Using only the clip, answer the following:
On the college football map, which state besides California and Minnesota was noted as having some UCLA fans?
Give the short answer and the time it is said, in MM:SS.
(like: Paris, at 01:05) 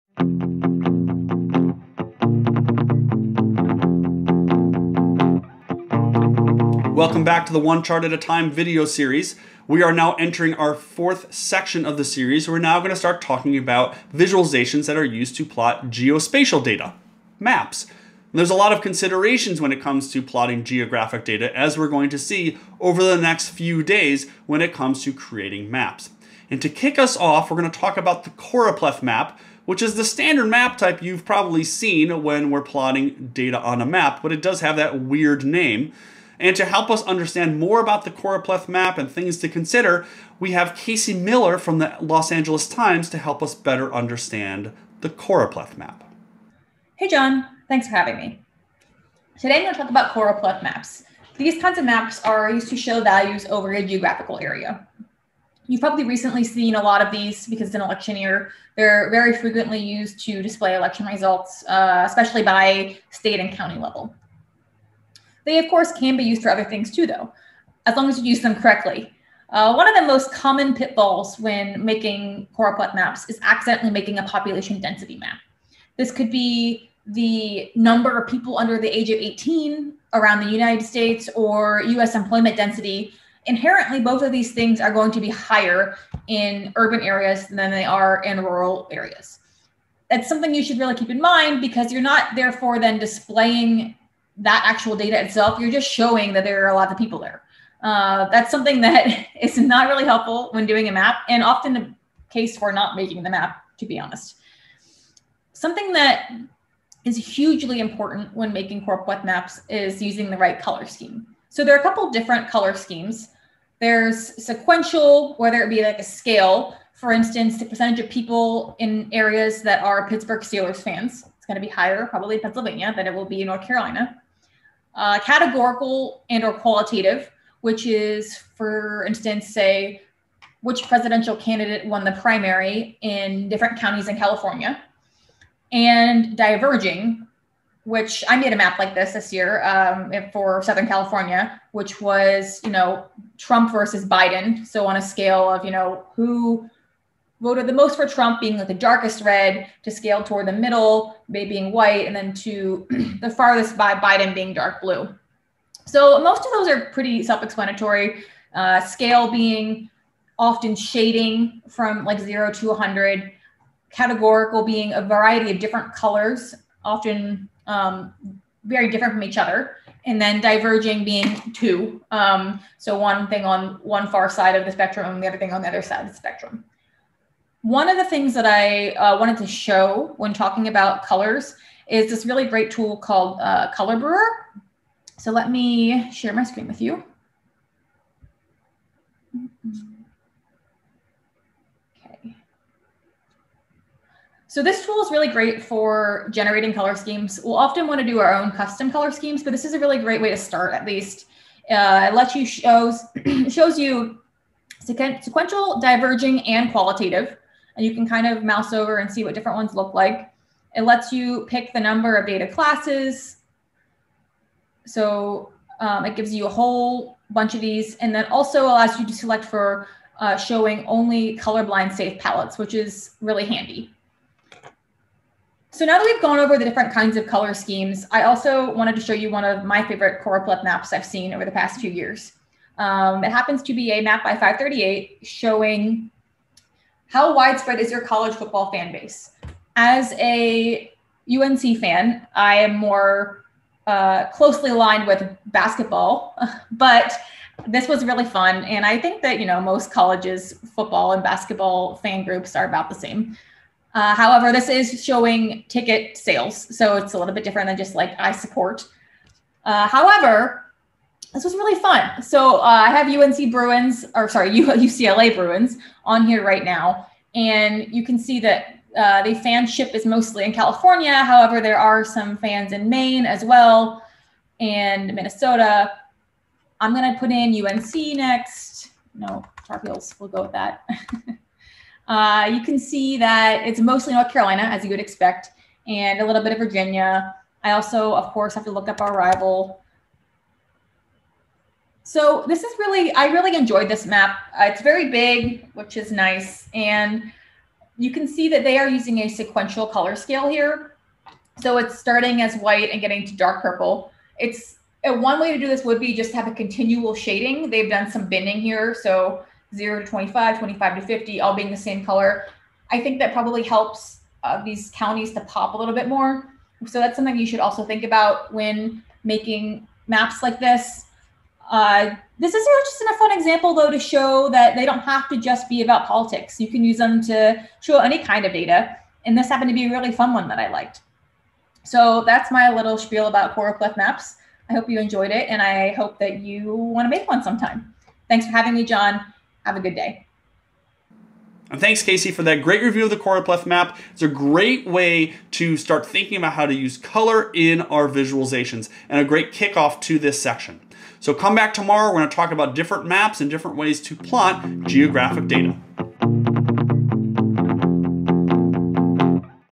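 Maine, at 04:32.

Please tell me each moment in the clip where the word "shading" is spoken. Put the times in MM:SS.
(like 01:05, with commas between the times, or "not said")
02:40, 05:07.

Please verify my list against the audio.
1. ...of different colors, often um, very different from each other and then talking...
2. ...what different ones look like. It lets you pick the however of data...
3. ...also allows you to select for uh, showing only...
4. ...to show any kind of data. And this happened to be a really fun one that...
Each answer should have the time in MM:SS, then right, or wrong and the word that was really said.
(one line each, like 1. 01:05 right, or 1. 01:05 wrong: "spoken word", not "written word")
1. 02:45 wrong: "diverging", not "talking"
2. 03:29 wrong: "number", not "however"
3. 03:38 right
4. 05:27 right.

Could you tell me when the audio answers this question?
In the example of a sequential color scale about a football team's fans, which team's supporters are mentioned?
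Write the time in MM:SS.
02:00.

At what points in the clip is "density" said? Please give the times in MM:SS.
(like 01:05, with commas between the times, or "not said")
01:14, 01:22.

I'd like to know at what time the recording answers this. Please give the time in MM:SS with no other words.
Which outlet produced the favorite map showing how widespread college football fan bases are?
03:54.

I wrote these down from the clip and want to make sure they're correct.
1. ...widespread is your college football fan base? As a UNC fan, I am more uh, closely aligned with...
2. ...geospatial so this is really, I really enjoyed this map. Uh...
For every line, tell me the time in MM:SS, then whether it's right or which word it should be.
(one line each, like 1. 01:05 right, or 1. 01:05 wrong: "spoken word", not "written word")
1. 03:57 right
2. 04:49 wrong: "rival", not "geospatial".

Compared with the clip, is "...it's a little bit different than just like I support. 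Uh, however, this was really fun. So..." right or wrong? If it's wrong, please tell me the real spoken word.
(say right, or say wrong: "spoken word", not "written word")
right.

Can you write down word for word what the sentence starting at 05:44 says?
It's a great way to start thinking about how to use color in our visualizations and a great kickoff to this section.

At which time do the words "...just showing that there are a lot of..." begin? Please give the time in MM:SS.
01:35.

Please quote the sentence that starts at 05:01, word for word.
So it's starting as white and getting to dark purple.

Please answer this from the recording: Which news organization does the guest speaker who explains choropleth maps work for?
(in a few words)
Los Angeles Times.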